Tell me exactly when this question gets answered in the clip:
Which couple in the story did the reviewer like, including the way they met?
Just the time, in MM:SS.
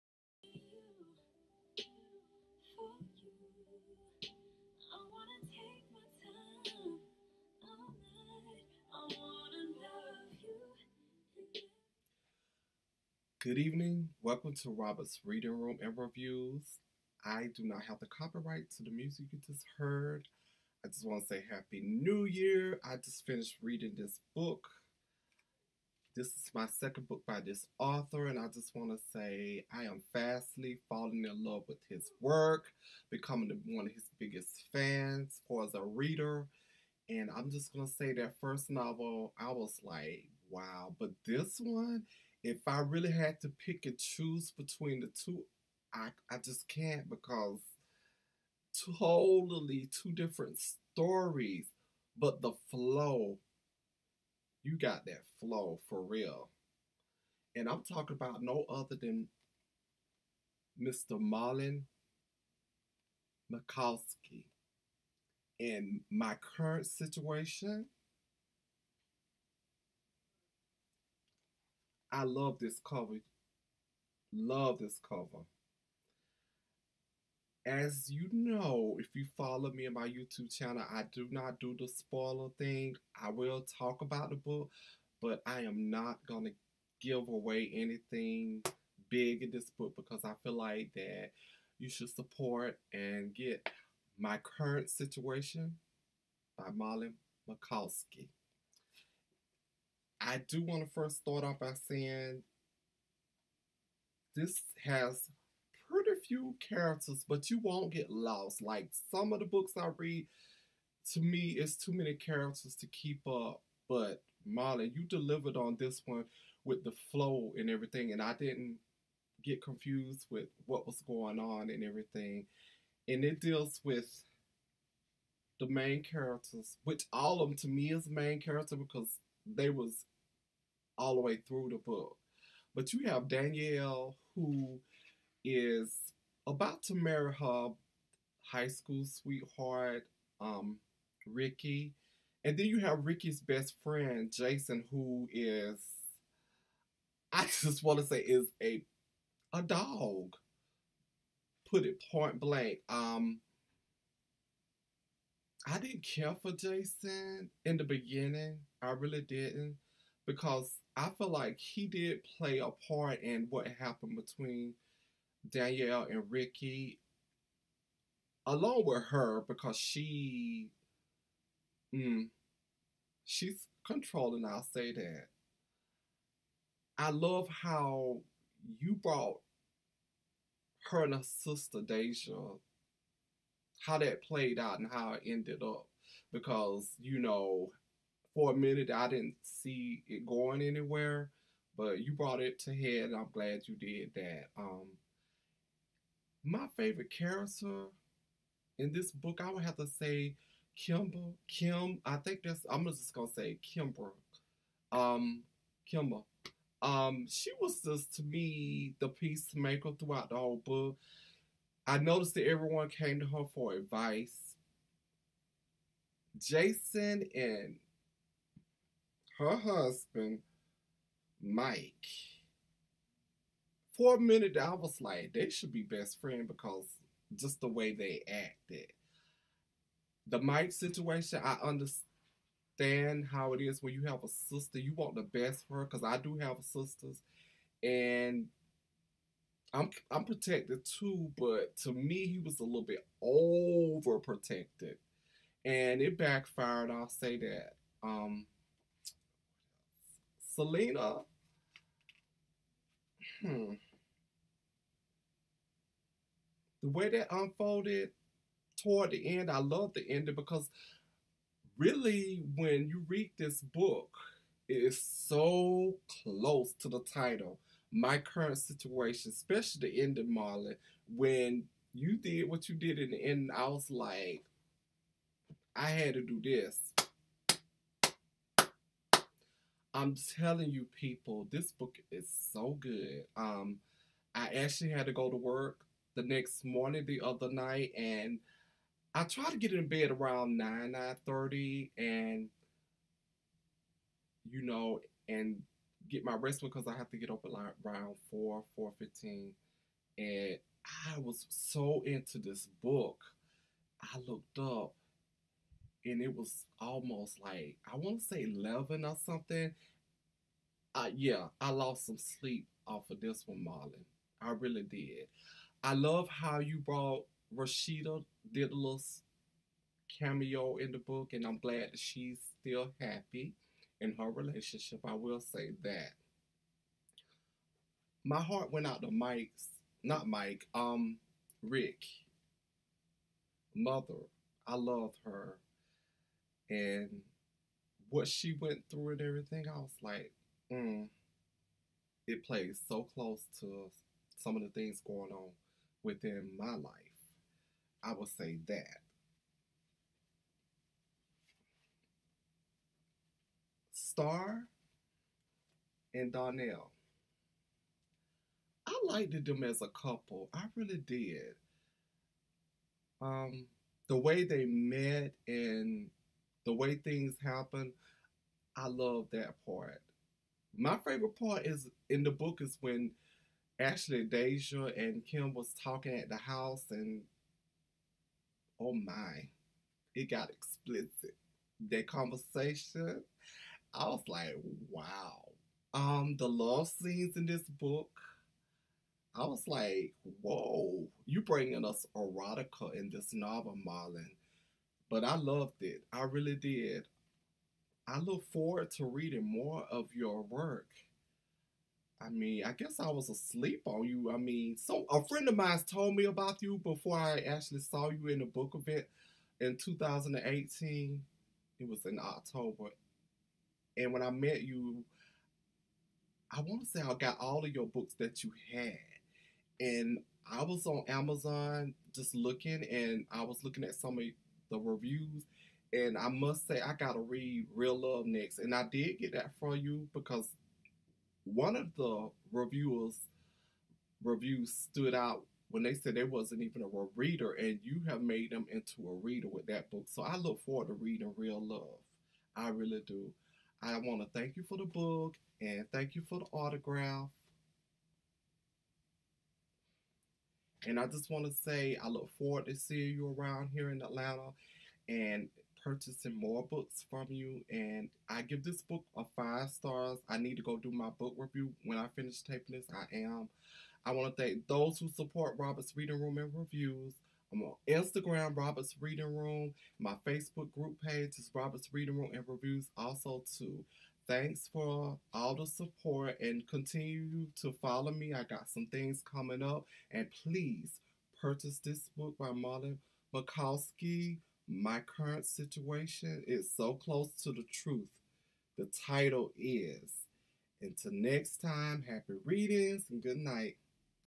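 05:53.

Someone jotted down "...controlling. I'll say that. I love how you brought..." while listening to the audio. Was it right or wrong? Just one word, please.
right.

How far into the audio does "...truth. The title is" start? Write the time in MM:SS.
08:07.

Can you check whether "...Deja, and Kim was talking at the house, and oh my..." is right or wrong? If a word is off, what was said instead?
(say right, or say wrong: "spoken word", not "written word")
right.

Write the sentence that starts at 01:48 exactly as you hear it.
Like some of the books I read, to me, it's too many characters to keep up.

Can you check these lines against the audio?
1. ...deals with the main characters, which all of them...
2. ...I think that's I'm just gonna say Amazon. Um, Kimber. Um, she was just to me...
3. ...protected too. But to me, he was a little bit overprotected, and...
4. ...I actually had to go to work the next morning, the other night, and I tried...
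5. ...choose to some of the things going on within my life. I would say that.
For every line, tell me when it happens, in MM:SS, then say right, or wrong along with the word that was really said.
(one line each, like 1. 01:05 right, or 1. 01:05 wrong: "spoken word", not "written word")
1. 02:03 right
2. 03:22 wrong: "Kimber", not "Amazon"
3. 04:00 right
4. 04:44 right
5. 05:43 wrong: "close", not "choose".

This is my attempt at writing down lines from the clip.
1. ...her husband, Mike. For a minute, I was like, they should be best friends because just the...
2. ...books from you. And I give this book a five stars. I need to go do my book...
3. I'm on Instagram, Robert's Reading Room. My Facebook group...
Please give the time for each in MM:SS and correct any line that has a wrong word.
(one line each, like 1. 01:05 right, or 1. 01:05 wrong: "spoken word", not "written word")
1. 03:39 right
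2. 07:36 right
3. 07:47 right.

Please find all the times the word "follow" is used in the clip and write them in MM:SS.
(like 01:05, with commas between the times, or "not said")
01:19, 07:57.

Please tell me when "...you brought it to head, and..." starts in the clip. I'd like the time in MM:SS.
03:11.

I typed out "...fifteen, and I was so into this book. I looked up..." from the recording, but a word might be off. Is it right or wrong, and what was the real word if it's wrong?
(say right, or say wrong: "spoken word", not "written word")
right.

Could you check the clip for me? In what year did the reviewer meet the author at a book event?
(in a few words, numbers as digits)
2018.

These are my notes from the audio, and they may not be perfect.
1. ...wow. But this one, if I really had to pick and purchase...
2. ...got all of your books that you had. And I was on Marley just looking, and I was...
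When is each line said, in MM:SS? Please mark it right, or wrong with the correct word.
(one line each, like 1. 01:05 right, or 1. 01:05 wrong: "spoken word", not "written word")
1. 00:40 wrong: "choose", not "purchase"
2. 06:57 wrong: "Amazon", not "Marley".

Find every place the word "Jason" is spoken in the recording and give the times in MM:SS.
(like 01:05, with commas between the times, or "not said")
02:24, 02:36, 03:36.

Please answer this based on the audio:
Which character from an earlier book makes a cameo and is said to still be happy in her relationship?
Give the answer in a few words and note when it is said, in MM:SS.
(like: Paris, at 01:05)
Rashida, at 05:17.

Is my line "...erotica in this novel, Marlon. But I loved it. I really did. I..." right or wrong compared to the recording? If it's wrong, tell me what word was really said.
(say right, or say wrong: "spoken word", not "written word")
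right.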